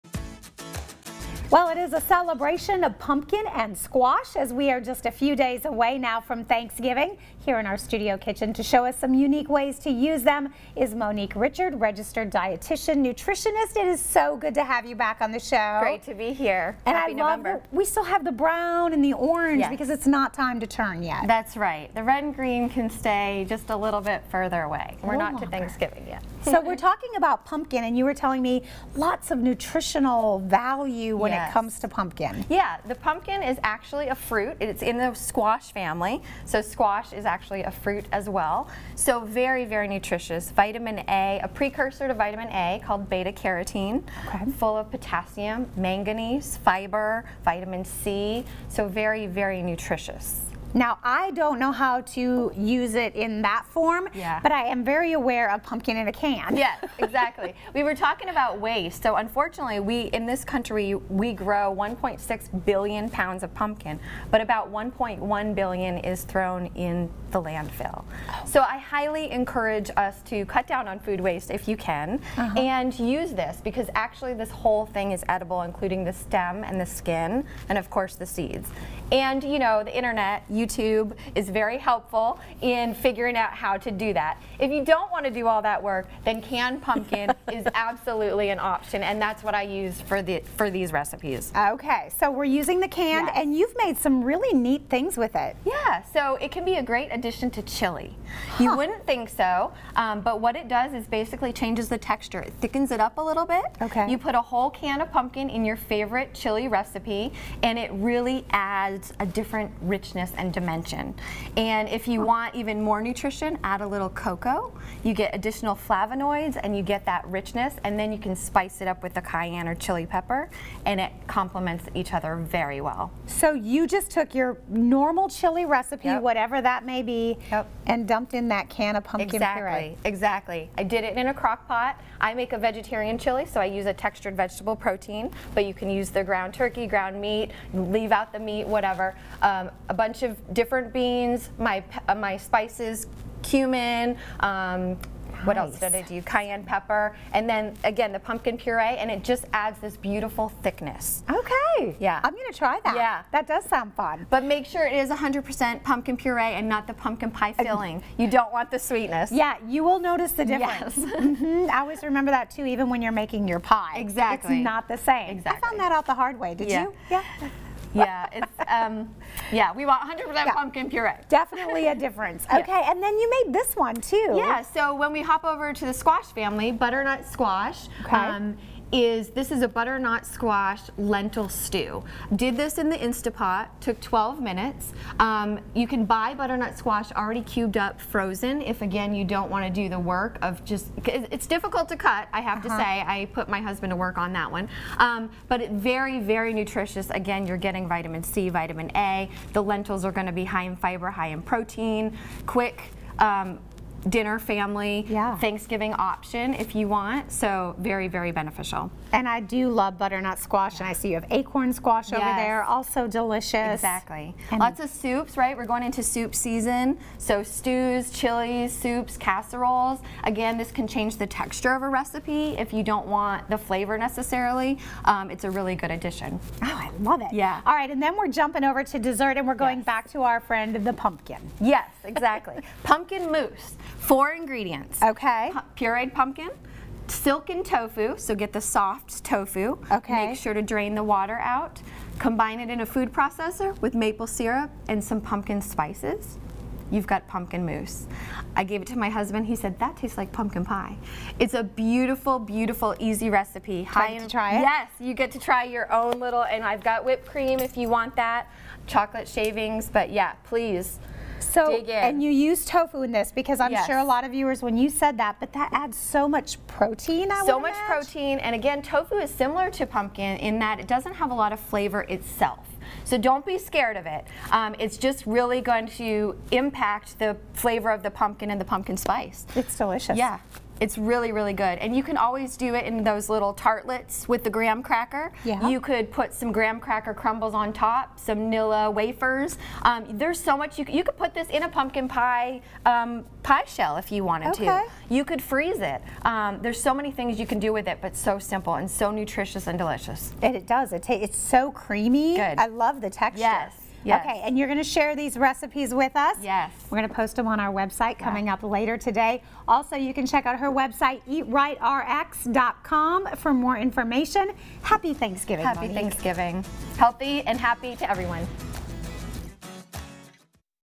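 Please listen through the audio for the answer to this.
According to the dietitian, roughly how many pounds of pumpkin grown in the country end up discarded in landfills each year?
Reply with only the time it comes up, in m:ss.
1:04.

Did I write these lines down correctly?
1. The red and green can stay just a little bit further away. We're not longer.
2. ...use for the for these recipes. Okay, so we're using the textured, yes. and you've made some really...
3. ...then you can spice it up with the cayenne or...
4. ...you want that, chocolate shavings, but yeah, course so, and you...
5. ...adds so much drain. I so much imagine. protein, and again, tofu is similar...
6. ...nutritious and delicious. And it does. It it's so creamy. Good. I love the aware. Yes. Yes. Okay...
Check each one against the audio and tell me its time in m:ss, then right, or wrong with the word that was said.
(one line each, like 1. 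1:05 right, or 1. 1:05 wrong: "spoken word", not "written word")
1. 0:21 right
2. 1:29 wrong: "canned", not "textured"
3. 1:57 right
4. 4:17 wrong: "please", not "course"
5. 4:25 wrong: "protein", not "drain"
6. 4:59 wrong: "texture", not "aware".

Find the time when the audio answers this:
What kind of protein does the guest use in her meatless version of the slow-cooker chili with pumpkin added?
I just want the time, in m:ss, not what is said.
2:13.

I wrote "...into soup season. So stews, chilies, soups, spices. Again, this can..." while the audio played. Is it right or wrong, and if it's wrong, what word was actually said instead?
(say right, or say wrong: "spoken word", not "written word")
wrong: "casseroles", not "spices".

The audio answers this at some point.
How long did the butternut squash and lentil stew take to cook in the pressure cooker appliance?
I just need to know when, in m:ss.
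3:04.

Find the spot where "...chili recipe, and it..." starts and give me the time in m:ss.
1:46.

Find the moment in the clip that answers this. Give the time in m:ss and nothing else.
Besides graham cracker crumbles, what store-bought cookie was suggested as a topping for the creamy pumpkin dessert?
4:48.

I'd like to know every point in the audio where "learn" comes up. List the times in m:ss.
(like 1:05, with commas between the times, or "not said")
not said.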